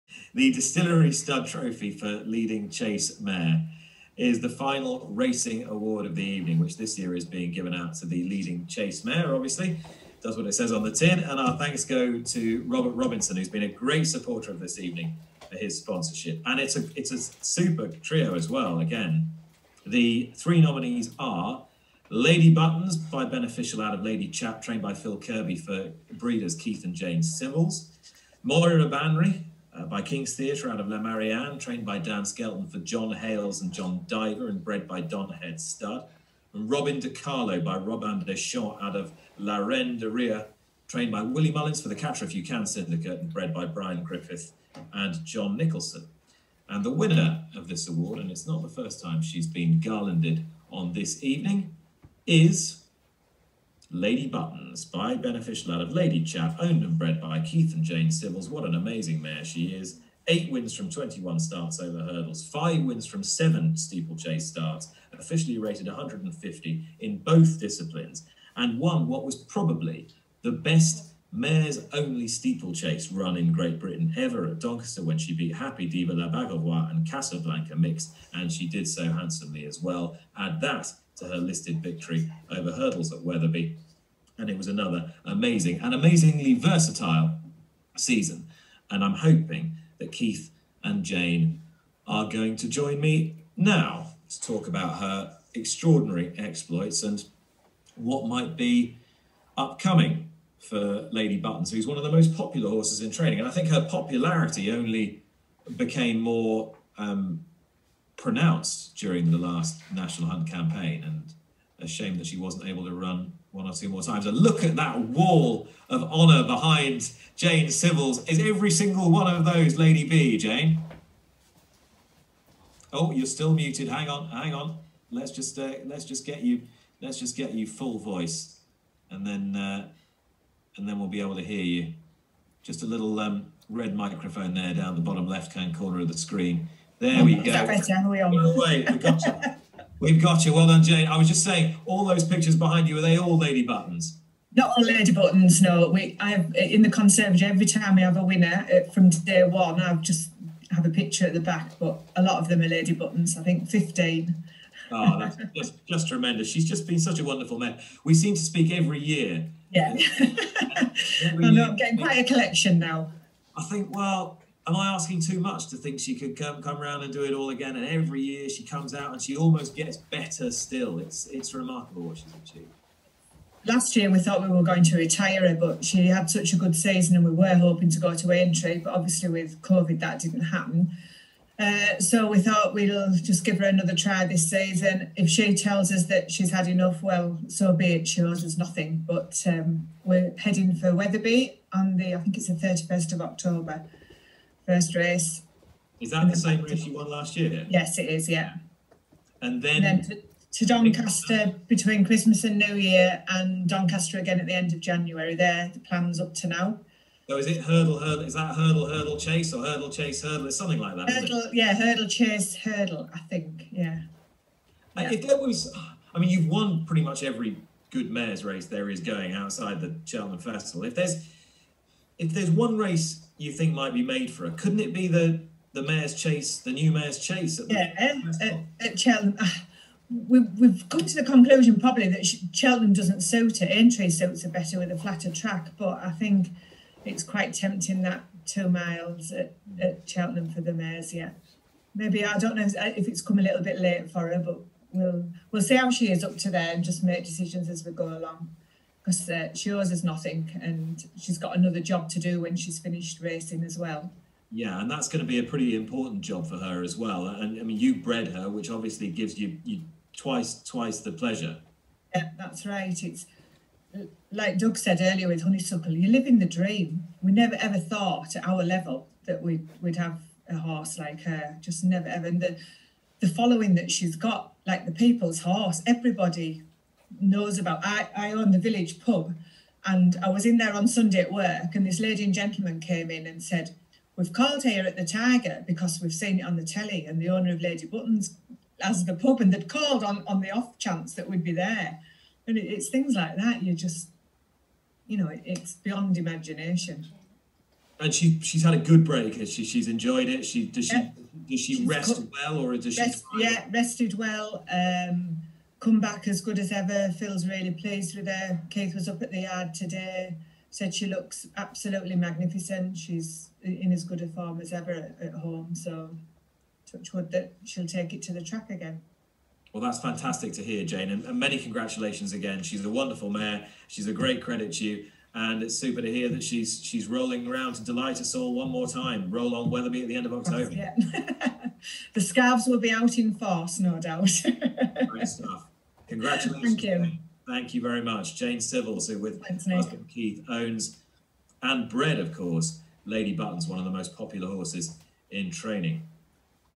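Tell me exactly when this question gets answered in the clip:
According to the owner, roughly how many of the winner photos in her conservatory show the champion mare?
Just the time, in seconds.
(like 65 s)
153 s.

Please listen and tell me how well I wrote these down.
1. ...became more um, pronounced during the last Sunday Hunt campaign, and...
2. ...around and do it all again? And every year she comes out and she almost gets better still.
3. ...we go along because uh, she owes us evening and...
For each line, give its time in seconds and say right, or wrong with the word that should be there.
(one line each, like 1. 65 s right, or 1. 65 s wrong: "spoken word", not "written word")
1. 105 s wrong: "National", not "Sunday"
2. 166 s right
3. 247 s wrong: "nothing", not "evening".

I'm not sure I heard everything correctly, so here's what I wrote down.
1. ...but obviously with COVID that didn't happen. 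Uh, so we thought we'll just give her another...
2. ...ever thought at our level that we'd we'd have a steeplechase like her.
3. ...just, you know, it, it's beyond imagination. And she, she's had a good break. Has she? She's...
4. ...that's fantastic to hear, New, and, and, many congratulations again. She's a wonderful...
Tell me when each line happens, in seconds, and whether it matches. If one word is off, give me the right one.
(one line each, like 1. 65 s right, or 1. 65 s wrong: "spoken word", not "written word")
1. 178 s right
2. 267 s wrong: "horse", not "steeplechase"
3. 293 s right
4. 319 s wrong: "Jane", not "New".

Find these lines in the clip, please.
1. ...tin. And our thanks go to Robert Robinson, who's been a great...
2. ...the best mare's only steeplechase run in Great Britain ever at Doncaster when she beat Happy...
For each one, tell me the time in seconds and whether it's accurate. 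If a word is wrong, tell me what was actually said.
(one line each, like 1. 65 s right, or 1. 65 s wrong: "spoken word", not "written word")
1. 10 s right
2. 70 s right.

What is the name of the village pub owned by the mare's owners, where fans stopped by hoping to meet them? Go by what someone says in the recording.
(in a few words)
The Tiger.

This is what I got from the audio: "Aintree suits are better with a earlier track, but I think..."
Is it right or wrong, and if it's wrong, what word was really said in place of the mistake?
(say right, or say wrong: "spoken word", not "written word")
wrong: "flatter", not "earlier".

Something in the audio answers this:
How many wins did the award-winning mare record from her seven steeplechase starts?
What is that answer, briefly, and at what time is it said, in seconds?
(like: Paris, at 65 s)
5, at 62 s.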